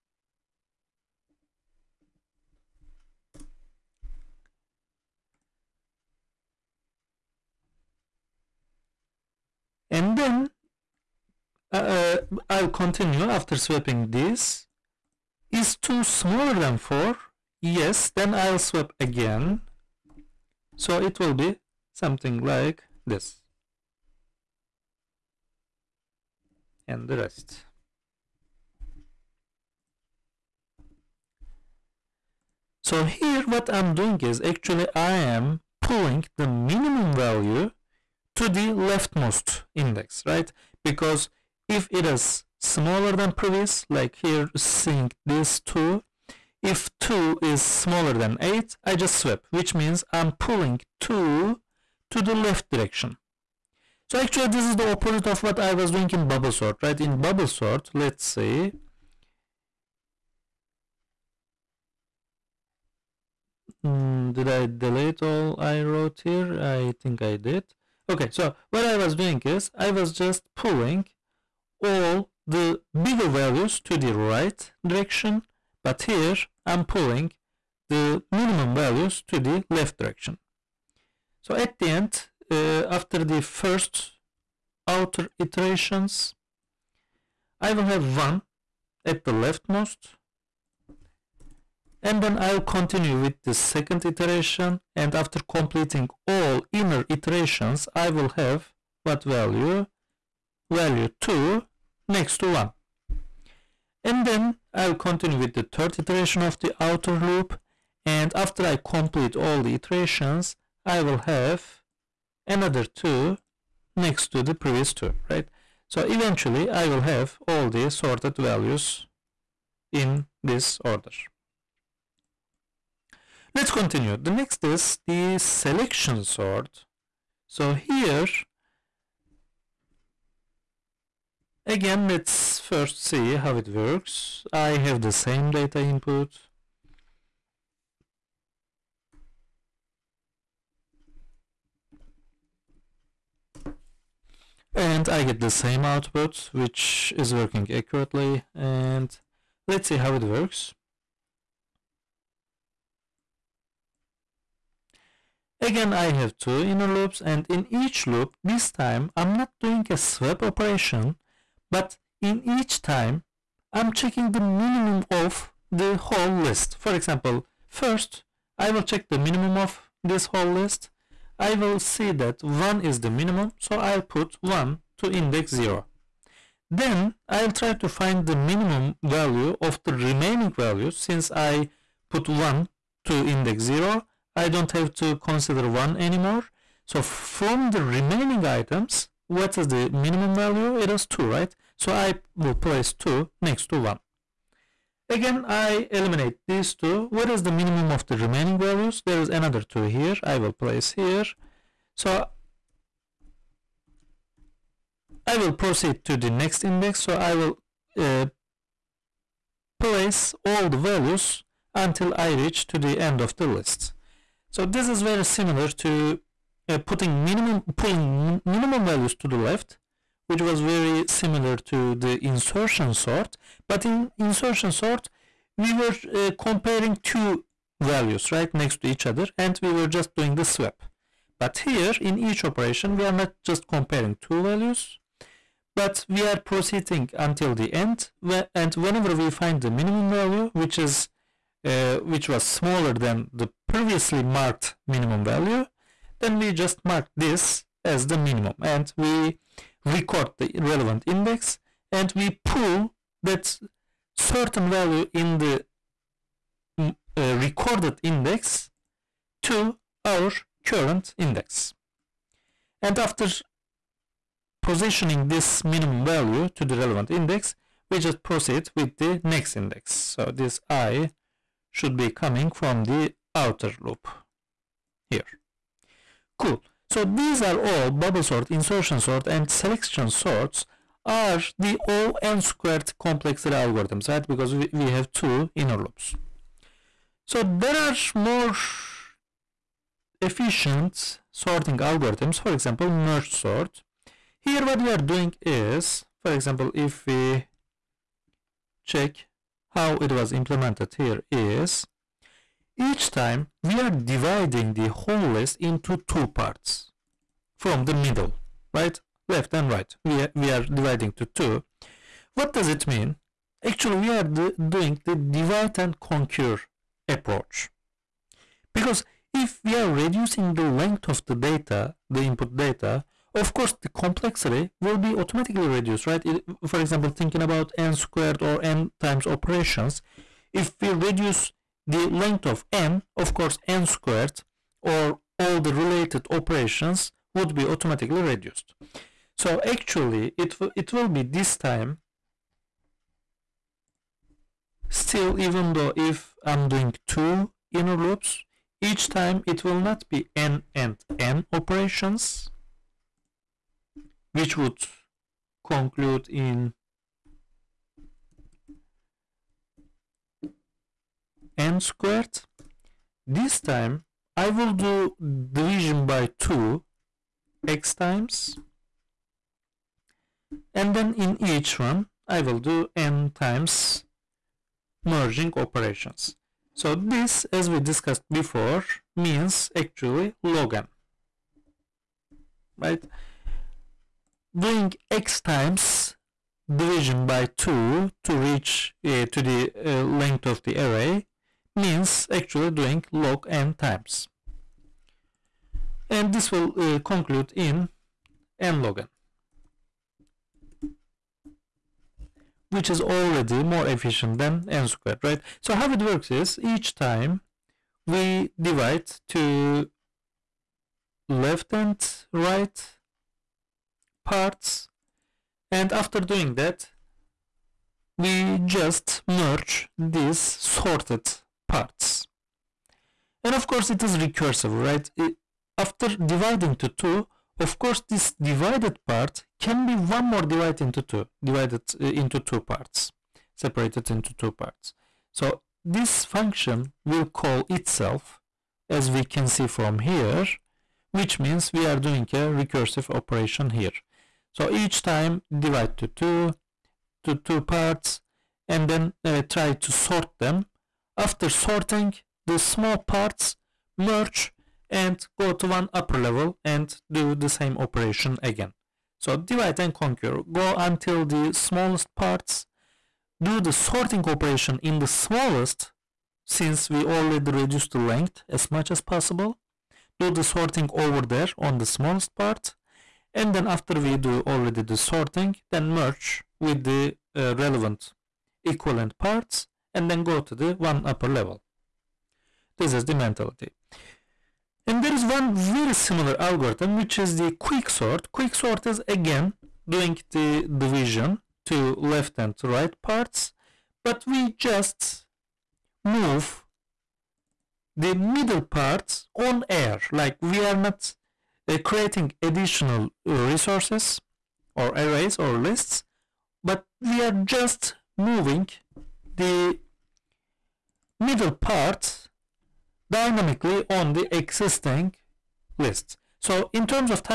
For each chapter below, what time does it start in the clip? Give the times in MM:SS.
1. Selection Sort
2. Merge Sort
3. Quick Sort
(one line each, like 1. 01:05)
1. 02:06
2. 04:54
3. 08:06.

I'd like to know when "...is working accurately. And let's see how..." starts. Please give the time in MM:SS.
02:27.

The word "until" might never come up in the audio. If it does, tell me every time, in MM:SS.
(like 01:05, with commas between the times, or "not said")
03:31, 03:57, 07:40.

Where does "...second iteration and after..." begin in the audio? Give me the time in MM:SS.
01:33.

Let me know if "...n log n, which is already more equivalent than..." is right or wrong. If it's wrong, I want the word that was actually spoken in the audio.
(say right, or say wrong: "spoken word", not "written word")
wrong: "efficient", not "equivalent".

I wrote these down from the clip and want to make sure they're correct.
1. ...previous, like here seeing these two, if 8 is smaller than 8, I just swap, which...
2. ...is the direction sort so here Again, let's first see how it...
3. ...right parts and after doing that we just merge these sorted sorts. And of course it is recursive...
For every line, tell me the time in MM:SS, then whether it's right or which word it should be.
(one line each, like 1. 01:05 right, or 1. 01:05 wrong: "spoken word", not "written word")
1. 00:43 wrong: "2", not "8"
2. 02:04 wrong: "selection", not "direction"
3. 06:52 wrong: "parts", not "sorts".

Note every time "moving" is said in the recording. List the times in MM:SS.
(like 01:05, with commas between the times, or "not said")
08:28.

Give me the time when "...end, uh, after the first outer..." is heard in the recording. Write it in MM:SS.
01:21.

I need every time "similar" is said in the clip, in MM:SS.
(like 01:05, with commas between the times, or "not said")
03:35, 03:41, 08:05.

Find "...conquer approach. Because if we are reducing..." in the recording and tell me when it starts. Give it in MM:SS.
05:15.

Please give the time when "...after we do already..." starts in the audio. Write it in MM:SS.
07:53.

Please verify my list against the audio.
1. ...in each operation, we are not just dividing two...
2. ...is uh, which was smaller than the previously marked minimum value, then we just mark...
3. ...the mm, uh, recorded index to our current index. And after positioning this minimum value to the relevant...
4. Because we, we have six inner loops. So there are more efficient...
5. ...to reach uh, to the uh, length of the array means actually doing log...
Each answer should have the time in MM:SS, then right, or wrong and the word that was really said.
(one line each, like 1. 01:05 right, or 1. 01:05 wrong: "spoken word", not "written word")
1. 03:51 wrong: "comparing", not "dividing"
2. 04:00 right
3. 04:15 right
4. 04:44 wrong: "two", not "six"
5. 06:28 right.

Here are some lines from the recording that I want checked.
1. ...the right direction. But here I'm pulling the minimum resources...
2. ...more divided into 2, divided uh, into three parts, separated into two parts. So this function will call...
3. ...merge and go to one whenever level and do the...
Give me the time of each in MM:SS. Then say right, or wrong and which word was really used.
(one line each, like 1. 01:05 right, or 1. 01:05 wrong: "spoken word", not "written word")
1. 01:13 wrong: "values", not "resources"
2. 07:10 wrong: "two", not "three"
3. 07:33 wrong: "upper", not "whenever".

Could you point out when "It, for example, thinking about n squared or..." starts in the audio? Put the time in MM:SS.
05:26.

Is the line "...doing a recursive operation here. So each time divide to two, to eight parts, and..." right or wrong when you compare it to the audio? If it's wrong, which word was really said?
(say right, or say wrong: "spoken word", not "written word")
wrong: "two", not "eight".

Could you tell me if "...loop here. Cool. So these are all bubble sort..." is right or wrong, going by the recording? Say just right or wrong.
right.